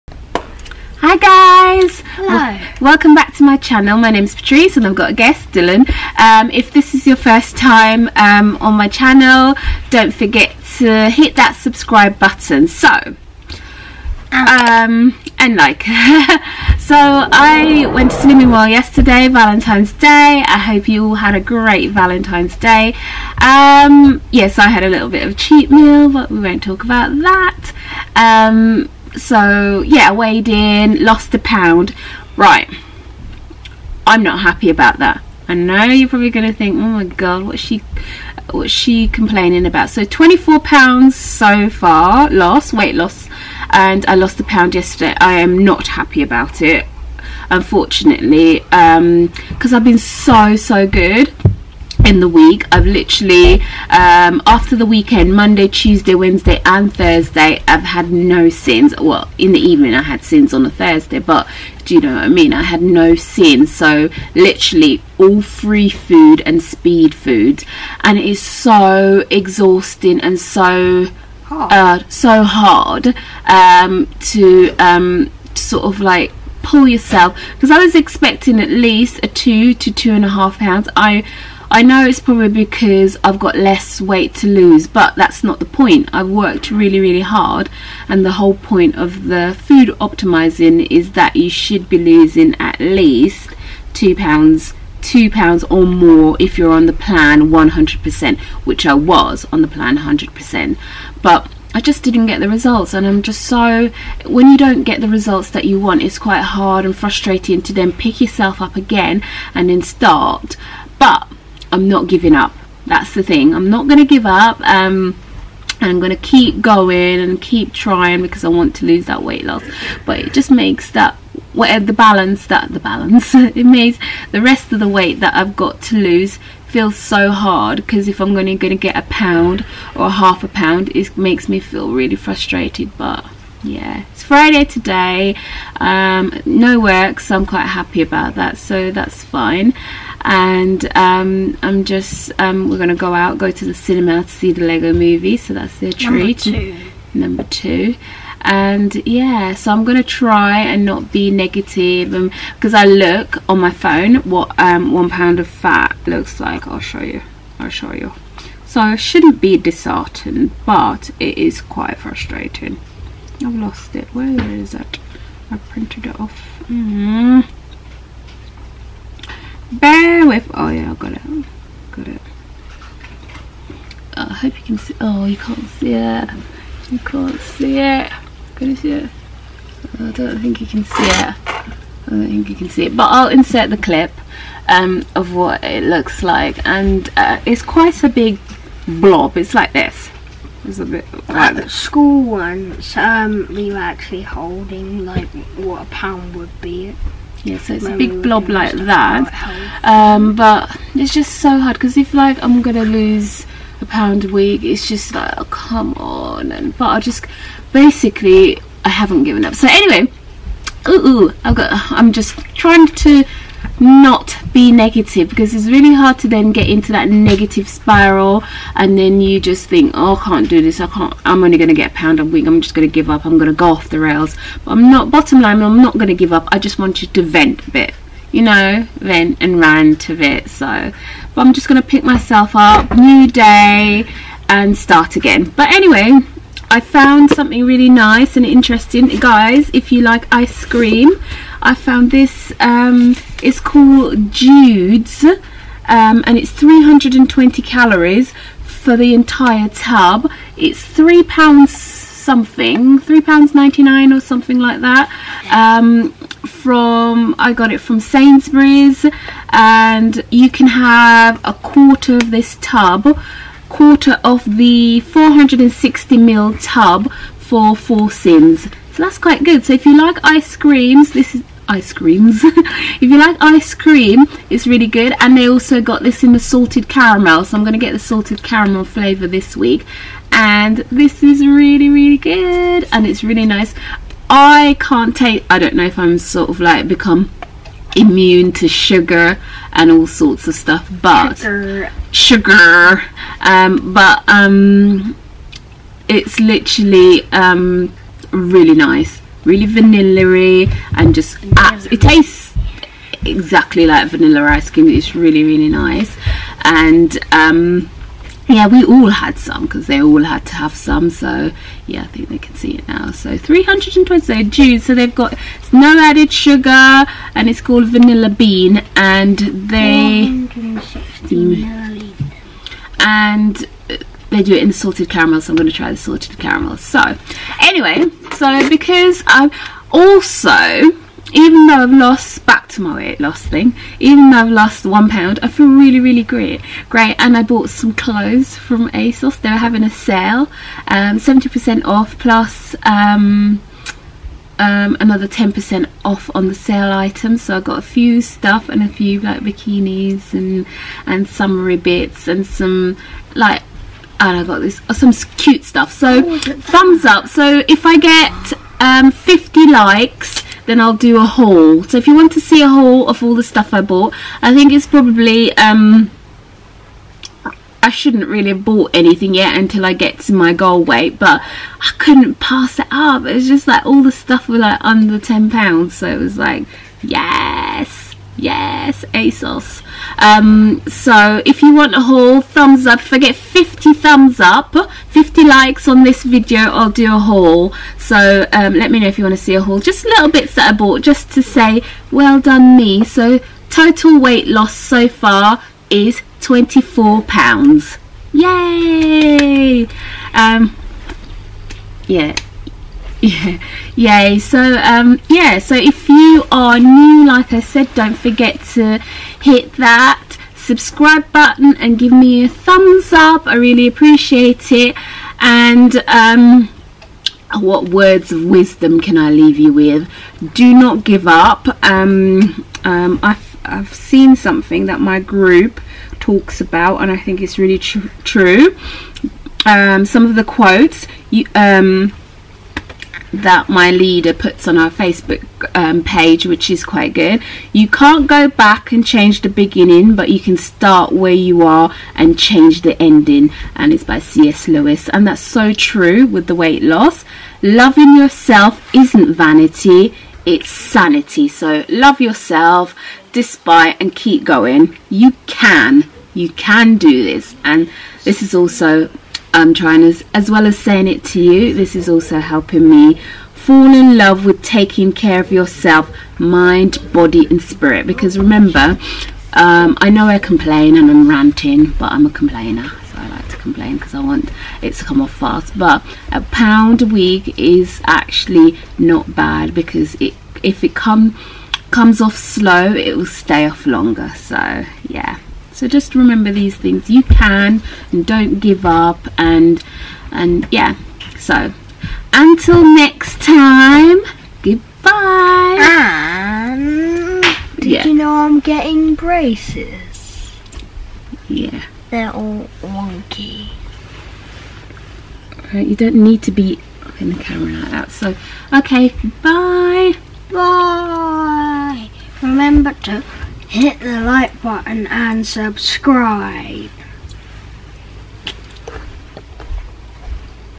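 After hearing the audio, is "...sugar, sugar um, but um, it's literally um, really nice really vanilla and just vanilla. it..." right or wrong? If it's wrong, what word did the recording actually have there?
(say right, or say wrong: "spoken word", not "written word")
right.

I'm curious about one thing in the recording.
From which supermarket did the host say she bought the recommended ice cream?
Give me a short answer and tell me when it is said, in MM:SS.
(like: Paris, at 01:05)
Sainsbury's, at 04:17.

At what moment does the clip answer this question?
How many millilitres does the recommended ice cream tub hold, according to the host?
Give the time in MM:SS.
04:24.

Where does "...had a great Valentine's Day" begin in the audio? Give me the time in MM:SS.
00:21.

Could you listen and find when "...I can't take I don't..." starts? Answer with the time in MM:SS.
04:44.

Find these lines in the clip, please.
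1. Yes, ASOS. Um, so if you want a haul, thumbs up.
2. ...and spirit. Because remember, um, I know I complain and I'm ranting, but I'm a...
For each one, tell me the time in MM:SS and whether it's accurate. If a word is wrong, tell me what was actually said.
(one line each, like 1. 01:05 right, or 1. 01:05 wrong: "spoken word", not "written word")
1. 06:18 right
2. 07:47 right.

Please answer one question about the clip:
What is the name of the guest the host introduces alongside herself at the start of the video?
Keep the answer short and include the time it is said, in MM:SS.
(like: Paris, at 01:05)
Dylan, at 00:05.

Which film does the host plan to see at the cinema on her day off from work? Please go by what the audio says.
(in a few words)
The Lego Movie.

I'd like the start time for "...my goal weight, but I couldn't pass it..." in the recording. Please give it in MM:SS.
06:10.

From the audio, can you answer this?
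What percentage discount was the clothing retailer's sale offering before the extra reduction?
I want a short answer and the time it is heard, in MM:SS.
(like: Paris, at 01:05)
70%, at 05:40.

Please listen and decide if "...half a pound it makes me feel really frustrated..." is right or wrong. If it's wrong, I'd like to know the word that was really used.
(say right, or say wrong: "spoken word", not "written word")
right.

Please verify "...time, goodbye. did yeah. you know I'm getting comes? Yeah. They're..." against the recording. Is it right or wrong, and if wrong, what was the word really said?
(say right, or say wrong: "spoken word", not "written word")
wrong: "braces", not "comes".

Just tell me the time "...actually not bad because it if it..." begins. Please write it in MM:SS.
07:58.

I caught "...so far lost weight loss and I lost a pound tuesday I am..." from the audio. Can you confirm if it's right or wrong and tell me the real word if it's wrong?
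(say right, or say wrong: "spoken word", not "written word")
wrong: "yesterday", not "tuesday".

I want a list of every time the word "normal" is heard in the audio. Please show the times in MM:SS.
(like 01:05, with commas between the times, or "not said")
not said.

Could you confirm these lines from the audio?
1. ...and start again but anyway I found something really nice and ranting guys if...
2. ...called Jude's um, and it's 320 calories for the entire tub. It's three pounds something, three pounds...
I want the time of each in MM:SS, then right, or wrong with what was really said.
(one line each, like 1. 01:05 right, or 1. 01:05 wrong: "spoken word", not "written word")
1. 03:54 wrong: "interesting", not "ranting"
2. 04:03 right.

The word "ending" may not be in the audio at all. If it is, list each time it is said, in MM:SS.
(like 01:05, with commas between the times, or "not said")
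07:23.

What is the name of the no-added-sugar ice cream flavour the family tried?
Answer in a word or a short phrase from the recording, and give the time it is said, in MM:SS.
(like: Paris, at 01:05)
Vanilla bean, at 05:17.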